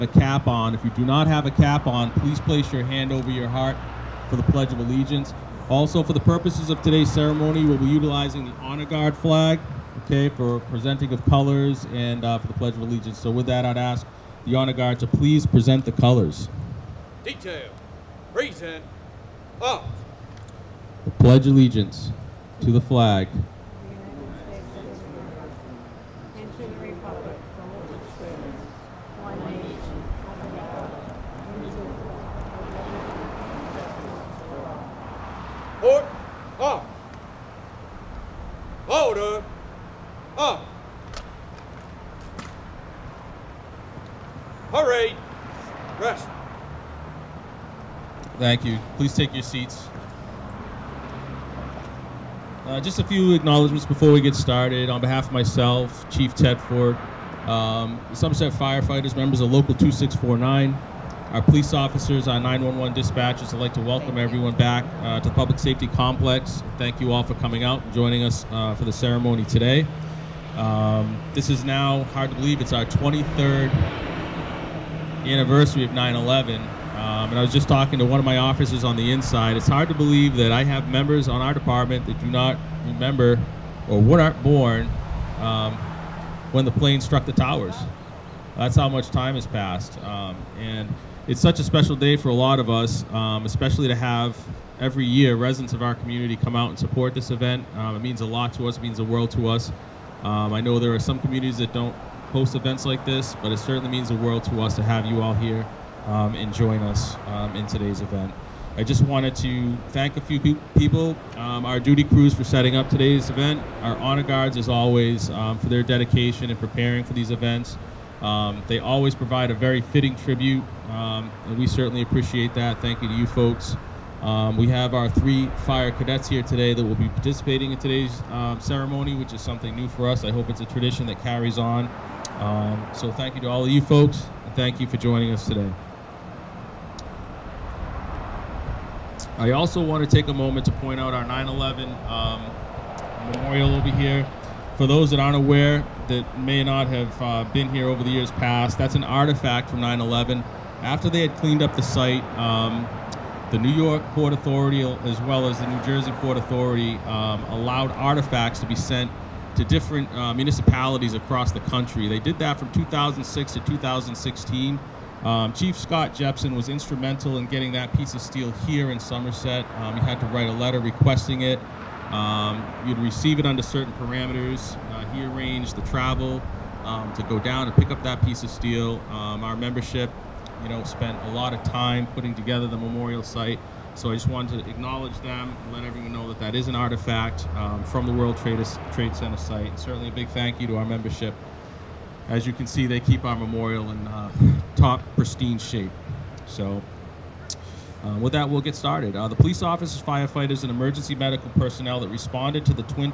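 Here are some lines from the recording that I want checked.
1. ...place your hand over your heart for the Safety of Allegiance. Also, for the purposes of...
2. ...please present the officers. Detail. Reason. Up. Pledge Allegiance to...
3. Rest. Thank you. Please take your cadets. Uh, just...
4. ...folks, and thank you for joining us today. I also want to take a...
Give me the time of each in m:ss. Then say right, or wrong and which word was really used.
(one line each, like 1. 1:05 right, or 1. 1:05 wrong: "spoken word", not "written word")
1. 0:02 wrong: "Pledge", not "Safety"
2. 0:15 wrong: "colors", not "officers"
3. 0:45 wrong: "seats", not "cadets"
4. 2:13 right.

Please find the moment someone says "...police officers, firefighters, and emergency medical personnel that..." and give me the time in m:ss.
3:19.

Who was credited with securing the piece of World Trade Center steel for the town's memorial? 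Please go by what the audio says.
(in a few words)
Chief Scott Jepson.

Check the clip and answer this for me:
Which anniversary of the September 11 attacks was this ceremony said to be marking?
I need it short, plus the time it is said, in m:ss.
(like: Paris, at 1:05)
23rd, at 1:12.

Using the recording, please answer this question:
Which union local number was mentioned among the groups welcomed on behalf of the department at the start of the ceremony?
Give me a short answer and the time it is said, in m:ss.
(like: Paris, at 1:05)
2649, at 0:59.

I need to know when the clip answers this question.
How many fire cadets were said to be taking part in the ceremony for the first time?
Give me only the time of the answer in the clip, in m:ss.
2:05.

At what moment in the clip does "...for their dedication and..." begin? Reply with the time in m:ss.
1:55.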